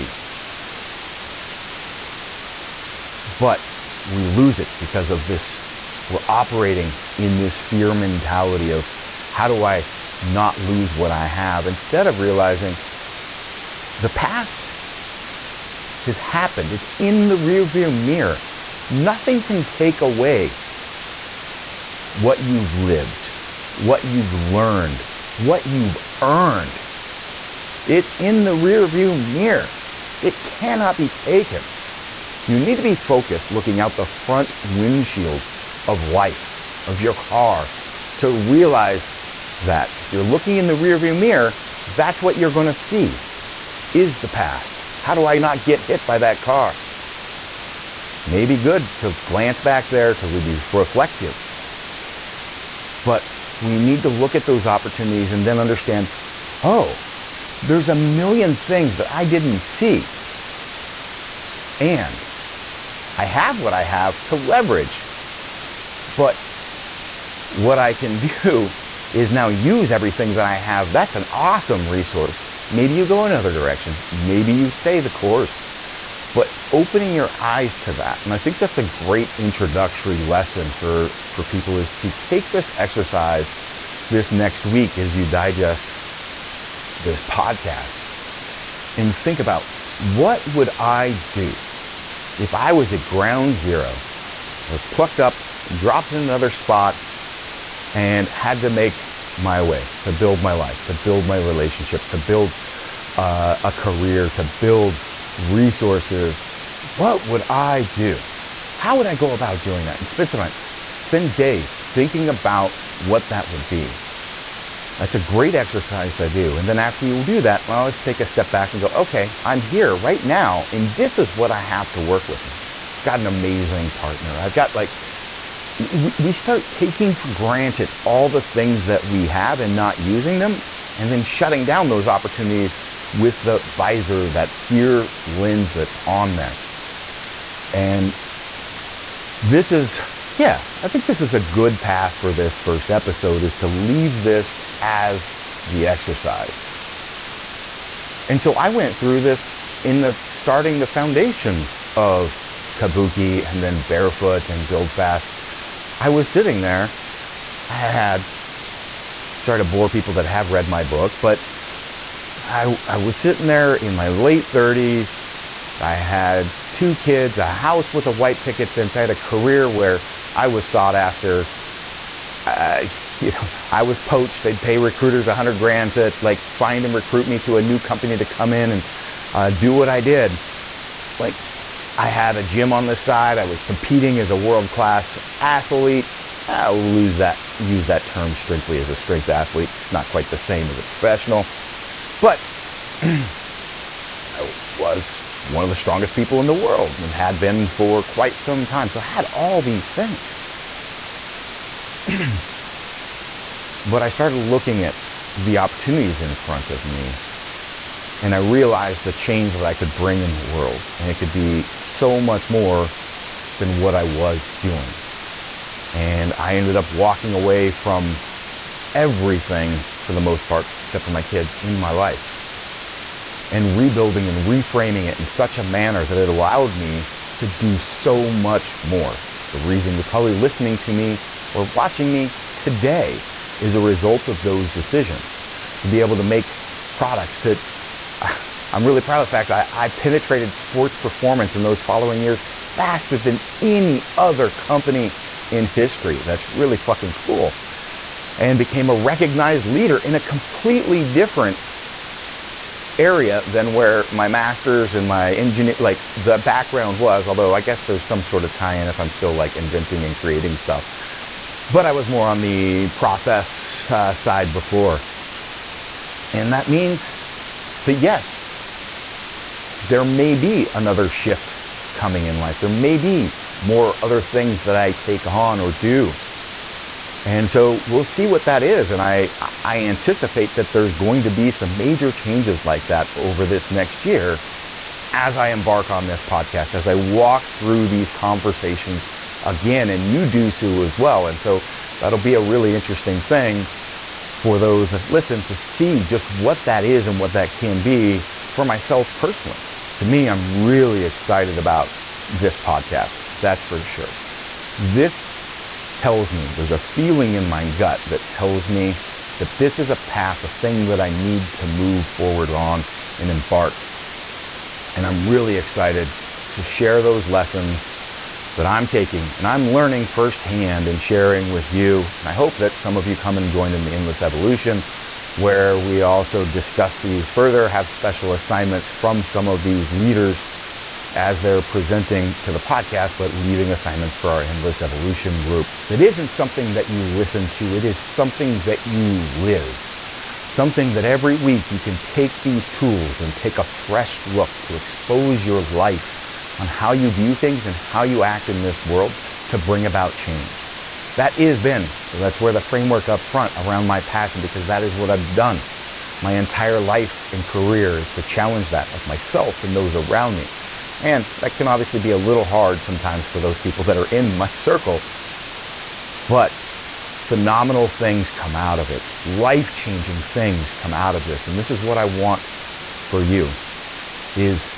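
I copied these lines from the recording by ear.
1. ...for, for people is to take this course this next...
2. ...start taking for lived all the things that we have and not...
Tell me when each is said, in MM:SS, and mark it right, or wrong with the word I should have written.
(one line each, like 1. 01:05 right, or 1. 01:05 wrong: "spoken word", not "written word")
1. 01:20 wrong: "exercise", not "course"
2. 02:06 wrong: "granted", not "lived".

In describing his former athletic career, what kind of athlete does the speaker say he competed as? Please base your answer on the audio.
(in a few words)
strength athlete.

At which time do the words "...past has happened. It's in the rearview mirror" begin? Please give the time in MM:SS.
00:14.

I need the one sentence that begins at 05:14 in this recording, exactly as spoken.
And I'm really excited to share those lessons that I'm taking and I'm learning firsthand and sharing with you.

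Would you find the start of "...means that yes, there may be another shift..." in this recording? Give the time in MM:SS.
04:26.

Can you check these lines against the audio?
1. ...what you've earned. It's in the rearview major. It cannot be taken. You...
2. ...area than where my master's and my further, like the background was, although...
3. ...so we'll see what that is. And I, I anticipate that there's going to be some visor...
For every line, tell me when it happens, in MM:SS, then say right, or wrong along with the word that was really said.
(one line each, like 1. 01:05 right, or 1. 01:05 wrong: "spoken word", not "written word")
1. 00:25 wrong: "mirror", not "major"
2. 04:12 wrong: "engineer", not "further"
3. 04:37 wrong: "major", not "visor".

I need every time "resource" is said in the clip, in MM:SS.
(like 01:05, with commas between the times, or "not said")
01:11, 01:45.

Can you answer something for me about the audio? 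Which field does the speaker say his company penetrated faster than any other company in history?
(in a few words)
sports performance.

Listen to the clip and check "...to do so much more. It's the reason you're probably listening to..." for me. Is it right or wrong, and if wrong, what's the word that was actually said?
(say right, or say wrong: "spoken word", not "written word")
right.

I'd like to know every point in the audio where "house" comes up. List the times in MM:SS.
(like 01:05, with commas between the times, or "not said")
02:47.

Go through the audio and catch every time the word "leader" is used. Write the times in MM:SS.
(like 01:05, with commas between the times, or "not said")
04:09, 05:29.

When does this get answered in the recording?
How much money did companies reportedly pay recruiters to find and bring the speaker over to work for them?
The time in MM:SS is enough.
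02:55.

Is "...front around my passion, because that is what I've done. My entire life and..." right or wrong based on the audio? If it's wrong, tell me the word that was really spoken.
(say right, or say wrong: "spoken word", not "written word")
right.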